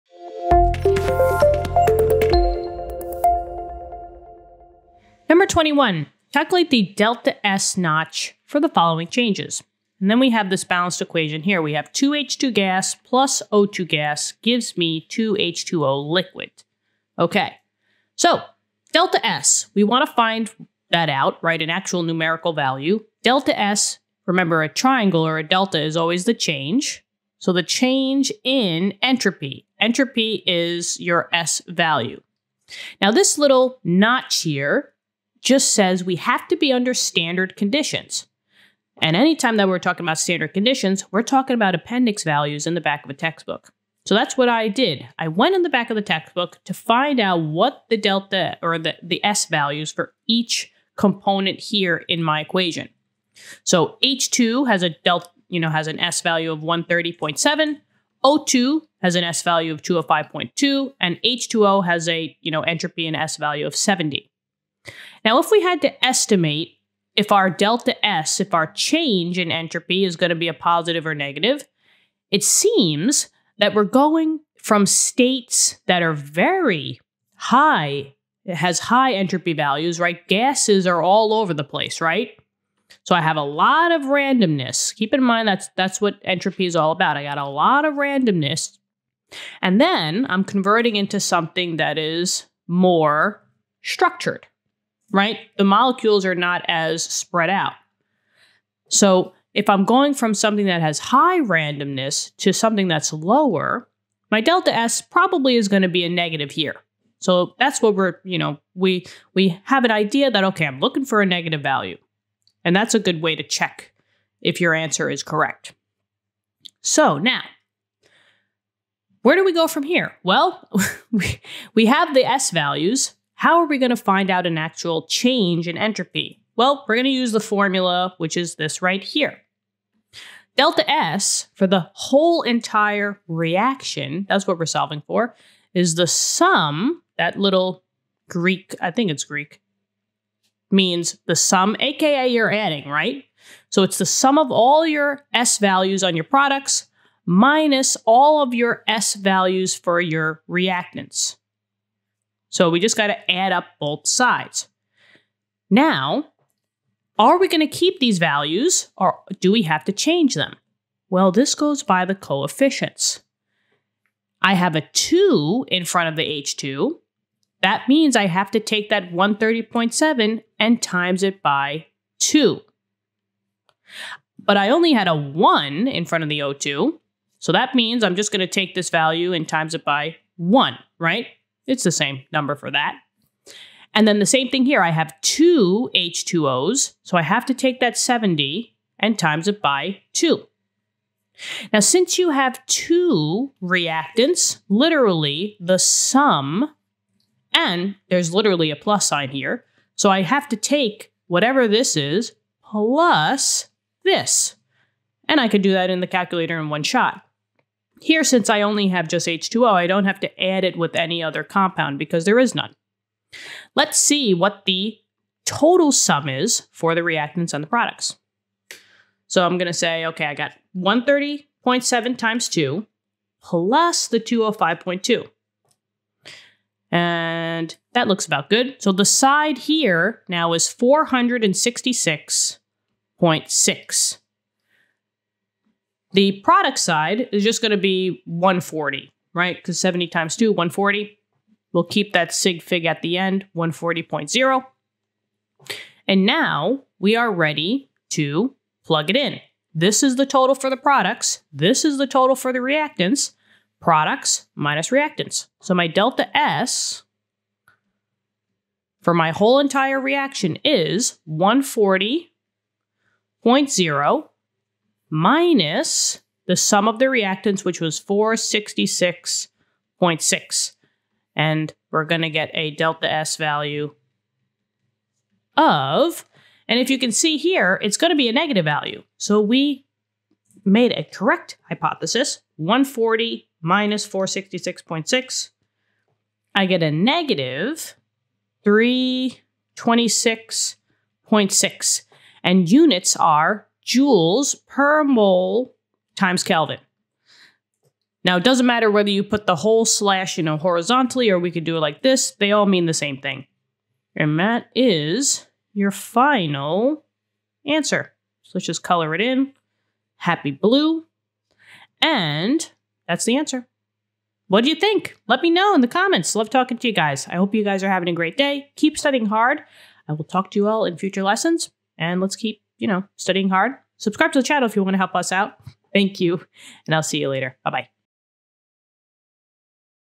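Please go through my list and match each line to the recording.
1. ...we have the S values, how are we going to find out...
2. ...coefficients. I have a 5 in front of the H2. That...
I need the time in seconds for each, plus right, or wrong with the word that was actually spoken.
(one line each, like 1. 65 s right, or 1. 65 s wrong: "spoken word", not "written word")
1. 121 s right
2. 162 s wrong: "2", not "5".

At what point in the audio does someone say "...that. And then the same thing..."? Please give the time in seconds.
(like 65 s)
182 s.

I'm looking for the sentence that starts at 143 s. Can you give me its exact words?
So it's the sum of all your S values on your products minus all of your S values for your reactants.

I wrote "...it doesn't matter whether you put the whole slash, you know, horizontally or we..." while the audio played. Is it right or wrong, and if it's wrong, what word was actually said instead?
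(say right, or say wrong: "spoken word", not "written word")
right.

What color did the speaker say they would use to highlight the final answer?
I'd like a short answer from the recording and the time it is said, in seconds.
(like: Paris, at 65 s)
blue, at 310 s.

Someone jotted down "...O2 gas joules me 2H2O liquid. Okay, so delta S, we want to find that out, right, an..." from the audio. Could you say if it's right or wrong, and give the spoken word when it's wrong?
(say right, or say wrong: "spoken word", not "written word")
wrong: "gives", not "joules".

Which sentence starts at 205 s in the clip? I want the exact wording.
And I could do that in the calculator in one shot.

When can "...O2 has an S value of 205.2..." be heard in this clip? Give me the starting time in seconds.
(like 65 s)
58 s.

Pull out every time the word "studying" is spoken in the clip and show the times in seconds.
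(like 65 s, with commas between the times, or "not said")
318 s, 323 s.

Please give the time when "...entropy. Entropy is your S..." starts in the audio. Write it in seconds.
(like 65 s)
29 s.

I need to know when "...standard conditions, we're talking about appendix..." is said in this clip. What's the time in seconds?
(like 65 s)
40 s.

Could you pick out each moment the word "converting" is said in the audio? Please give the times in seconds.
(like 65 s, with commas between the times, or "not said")
90 s.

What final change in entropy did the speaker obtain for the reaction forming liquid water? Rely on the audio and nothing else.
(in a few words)
-326.6.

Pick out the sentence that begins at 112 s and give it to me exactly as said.
And that's a good way to check if your answer is correct.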